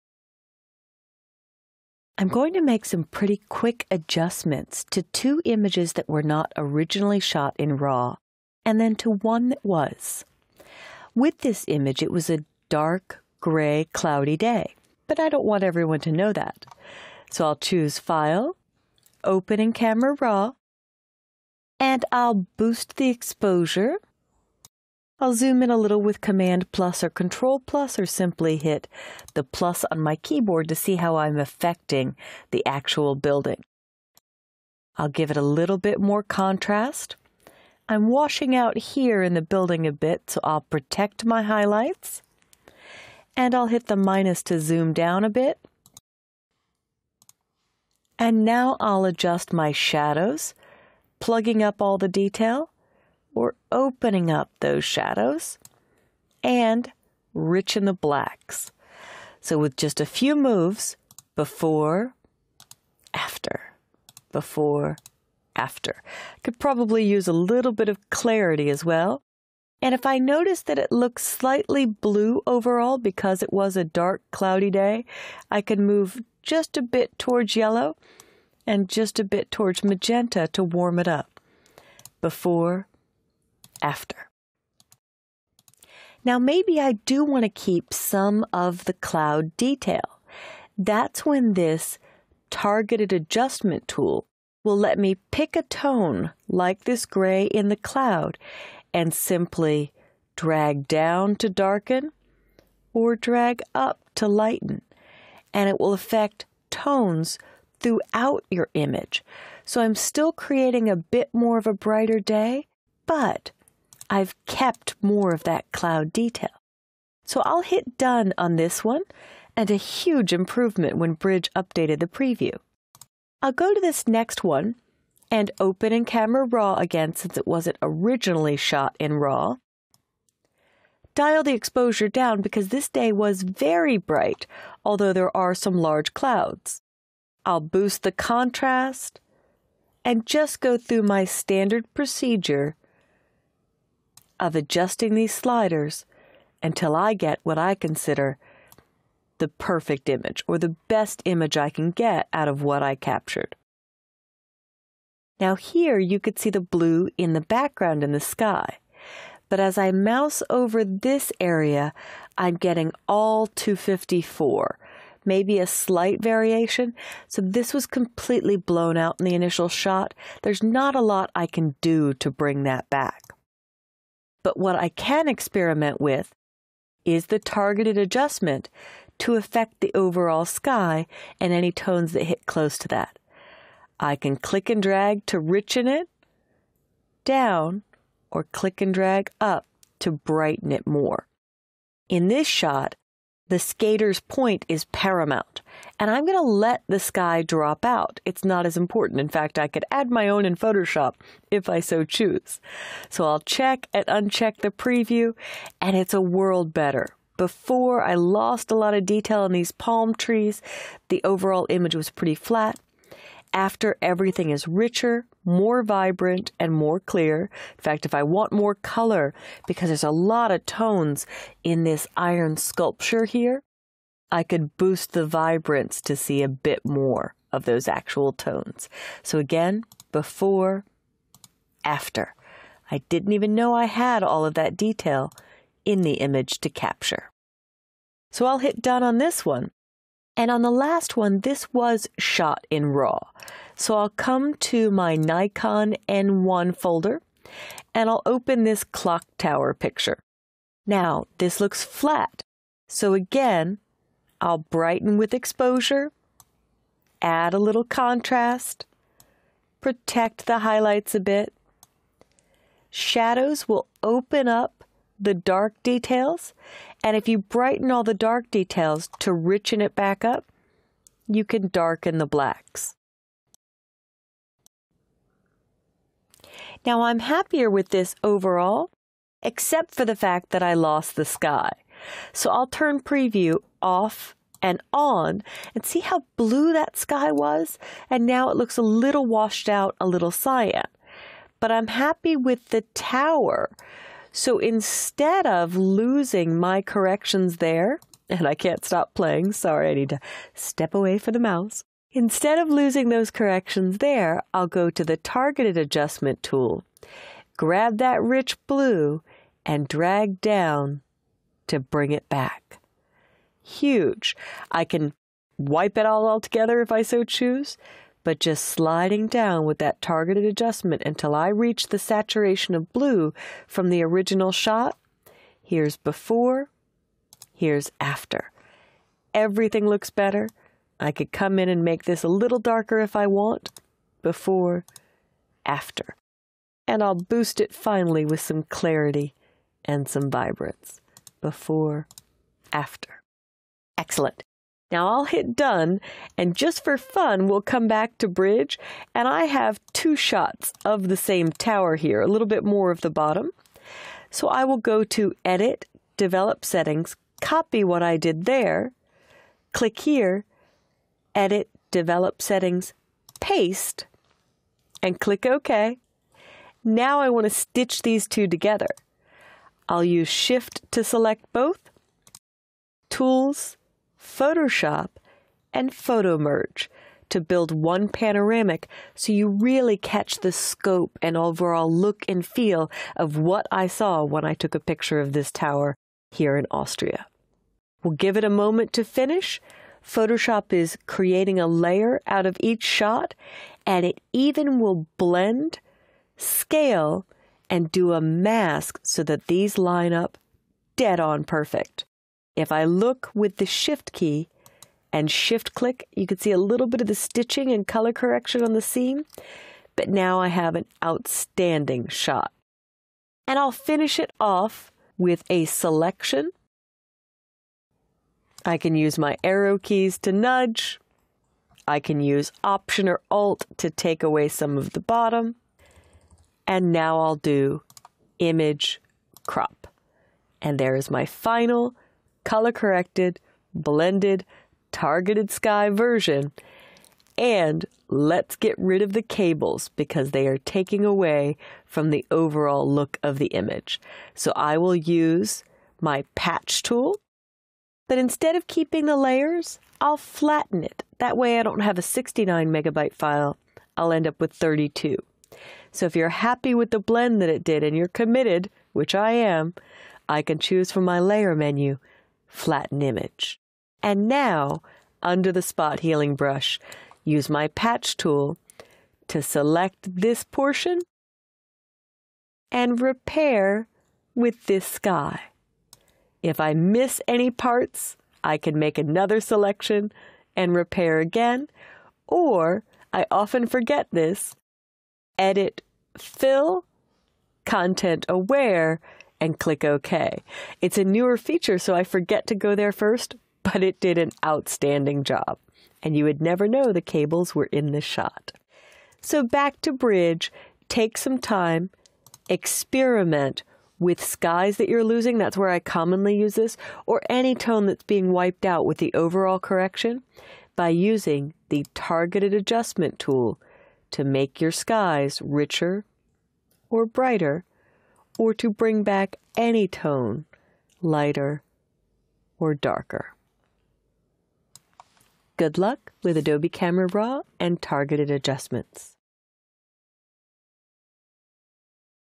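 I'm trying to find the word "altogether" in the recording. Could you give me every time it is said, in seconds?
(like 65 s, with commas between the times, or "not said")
316 s.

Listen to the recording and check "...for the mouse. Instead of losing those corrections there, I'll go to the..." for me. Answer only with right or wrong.
right.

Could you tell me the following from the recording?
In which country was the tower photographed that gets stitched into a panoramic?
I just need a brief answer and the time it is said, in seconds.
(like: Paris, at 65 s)
Austria, at 386 s.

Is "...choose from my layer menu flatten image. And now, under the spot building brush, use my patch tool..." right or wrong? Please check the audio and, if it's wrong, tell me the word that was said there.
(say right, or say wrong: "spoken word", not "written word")
wrong: "healing", not "building".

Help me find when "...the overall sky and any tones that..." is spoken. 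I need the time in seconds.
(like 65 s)
179 s.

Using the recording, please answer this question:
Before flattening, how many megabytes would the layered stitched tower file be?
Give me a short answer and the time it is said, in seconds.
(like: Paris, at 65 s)
69, at 452 s.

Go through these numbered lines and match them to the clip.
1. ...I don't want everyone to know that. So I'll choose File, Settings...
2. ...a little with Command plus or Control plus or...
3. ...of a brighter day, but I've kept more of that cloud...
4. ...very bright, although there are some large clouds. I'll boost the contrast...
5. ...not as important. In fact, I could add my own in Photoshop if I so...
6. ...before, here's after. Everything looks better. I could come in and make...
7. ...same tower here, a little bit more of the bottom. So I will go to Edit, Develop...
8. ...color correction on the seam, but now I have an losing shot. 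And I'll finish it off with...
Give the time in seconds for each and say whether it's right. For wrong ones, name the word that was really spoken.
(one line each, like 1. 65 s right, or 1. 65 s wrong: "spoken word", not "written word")
1. 15 s wrong: "Open", not "Settings"
2. 25 s right
3. 111 s right
4. 133 s right
5. 198 s right
6. 325 s right
7. 351 s right
8. 407 s wrong: "outstanding", not "losing".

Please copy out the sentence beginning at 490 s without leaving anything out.
It's a newer feature, so I forget to go there first, but it did an outstanding job.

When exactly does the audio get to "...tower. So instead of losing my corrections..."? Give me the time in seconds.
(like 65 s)
292 s.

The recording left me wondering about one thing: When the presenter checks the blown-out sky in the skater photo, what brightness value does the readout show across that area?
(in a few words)
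254.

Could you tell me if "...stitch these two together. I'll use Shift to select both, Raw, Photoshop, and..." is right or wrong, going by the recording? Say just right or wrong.
wrong.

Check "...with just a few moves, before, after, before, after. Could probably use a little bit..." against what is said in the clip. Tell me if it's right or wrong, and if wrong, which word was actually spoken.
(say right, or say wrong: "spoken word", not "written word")
right.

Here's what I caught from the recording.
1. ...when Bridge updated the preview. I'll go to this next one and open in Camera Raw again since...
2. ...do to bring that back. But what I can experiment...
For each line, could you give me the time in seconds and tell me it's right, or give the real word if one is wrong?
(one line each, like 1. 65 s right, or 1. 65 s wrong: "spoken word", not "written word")
1. 120 s right
2. 171 s right.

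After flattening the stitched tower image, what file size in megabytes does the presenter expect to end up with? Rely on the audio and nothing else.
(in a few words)
32.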